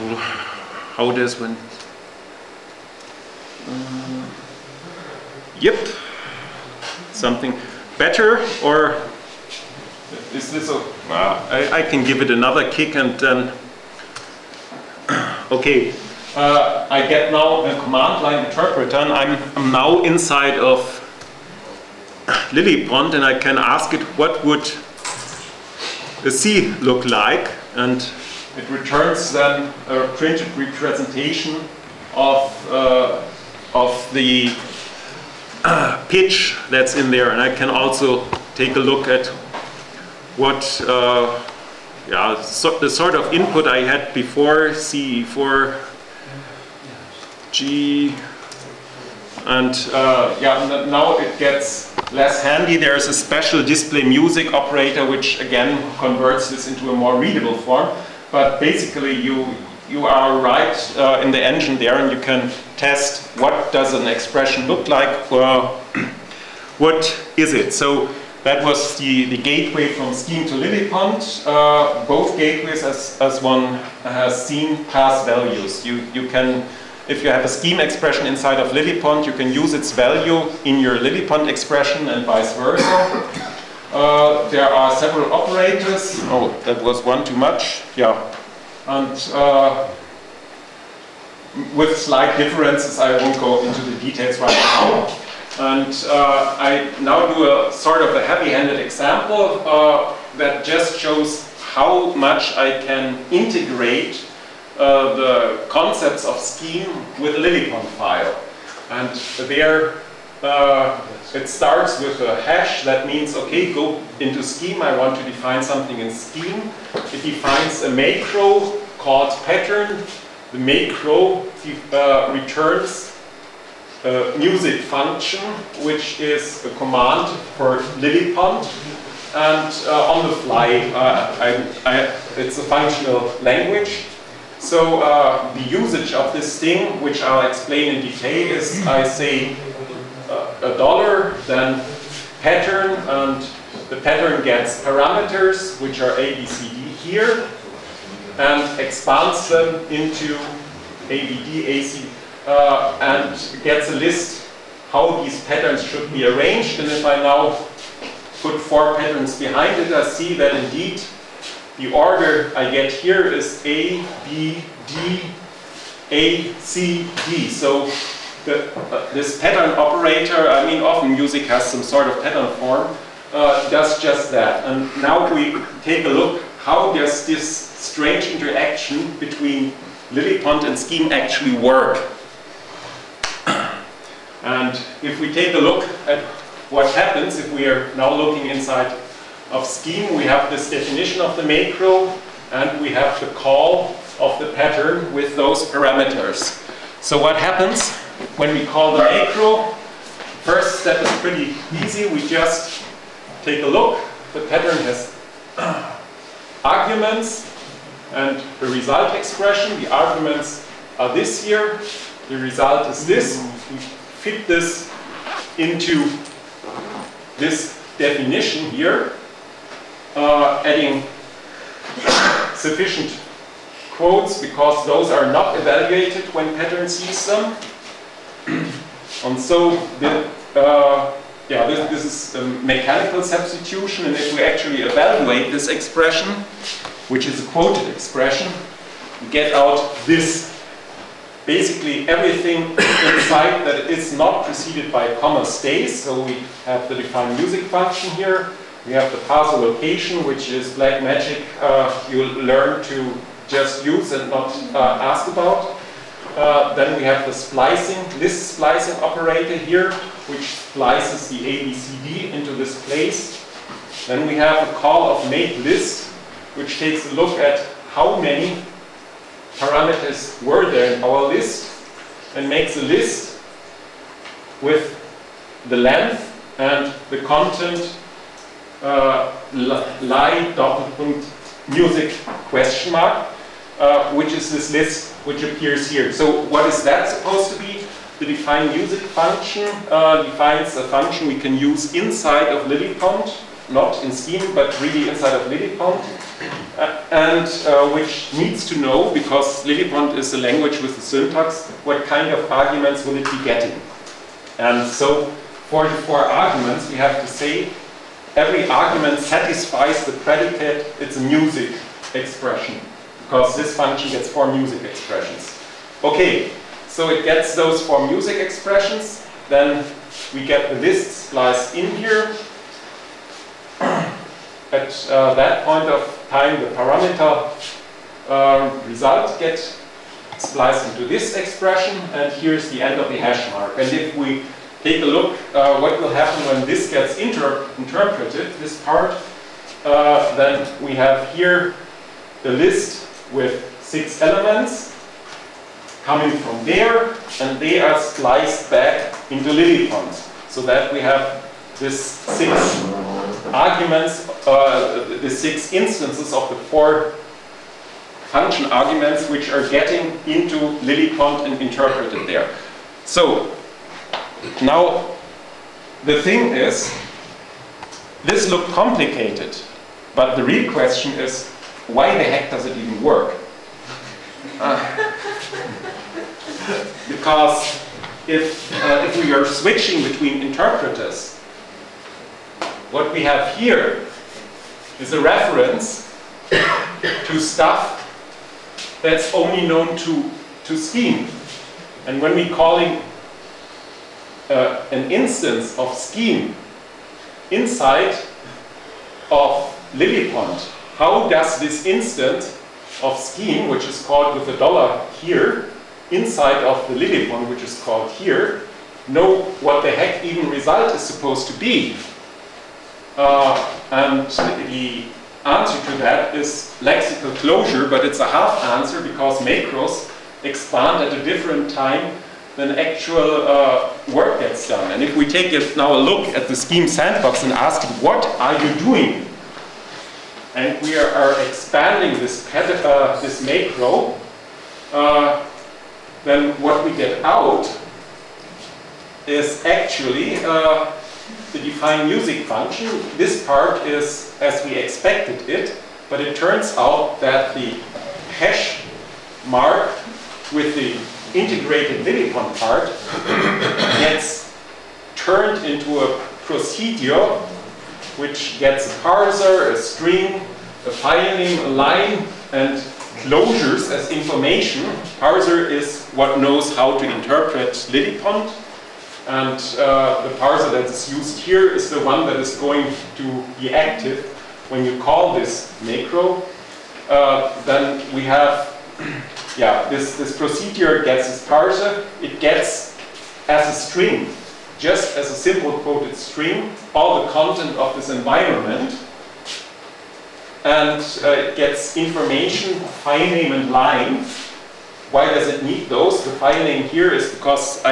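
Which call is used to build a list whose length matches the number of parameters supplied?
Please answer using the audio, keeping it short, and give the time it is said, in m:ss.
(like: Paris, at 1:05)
make list, at 4:25.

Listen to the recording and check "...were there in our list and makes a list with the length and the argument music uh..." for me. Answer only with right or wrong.
wrong.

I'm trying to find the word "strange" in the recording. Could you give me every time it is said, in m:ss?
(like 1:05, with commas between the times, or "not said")
2:57.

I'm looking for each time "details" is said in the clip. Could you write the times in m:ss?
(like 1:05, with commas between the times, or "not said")
1:33, 2:18.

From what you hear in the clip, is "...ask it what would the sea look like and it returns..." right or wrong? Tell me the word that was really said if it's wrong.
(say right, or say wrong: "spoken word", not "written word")
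right.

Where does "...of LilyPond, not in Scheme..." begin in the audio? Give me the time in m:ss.
4:52.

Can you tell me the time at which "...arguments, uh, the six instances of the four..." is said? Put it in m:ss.
5:53.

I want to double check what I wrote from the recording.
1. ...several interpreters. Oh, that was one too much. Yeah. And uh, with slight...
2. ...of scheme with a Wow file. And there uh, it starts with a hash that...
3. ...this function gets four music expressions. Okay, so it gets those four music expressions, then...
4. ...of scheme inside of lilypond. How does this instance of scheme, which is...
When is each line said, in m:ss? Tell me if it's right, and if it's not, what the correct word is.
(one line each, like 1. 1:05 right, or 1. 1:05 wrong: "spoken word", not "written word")
1. 1:24 wrong: "operators", not "interpreters"
2. 1:46 wrong: "LilyPond", not "Wow"
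3. 5:13 right
4. 6:35 right.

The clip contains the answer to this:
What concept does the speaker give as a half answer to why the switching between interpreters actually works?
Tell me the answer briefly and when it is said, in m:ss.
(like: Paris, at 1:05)
lexical closure, at 6:56.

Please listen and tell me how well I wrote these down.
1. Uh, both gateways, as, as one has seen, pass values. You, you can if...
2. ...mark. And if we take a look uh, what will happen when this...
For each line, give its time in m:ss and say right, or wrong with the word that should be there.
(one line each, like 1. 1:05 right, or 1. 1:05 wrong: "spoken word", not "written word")
1. 1:11 right
2. 5:33 right.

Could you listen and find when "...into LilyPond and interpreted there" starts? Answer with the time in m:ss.
6:00.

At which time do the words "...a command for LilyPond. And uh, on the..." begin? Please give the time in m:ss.
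2:06.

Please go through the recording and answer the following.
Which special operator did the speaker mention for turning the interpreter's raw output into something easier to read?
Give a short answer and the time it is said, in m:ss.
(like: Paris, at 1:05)
display music, at 0:53.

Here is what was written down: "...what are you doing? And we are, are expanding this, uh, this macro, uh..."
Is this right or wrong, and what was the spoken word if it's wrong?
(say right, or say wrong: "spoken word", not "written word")
right.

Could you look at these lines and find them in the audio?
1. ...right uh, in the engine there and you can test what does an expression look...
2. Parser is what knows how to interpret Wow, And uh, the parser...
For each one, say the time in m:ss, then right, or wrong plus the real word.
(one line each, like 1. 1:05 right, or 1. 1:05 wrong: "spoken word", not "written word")
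1. 1:00 right
2. 7:45 wrong: "Lilypond", not "Wow".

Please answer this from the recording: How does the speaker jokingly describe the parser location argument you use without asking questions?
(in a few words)
black magic.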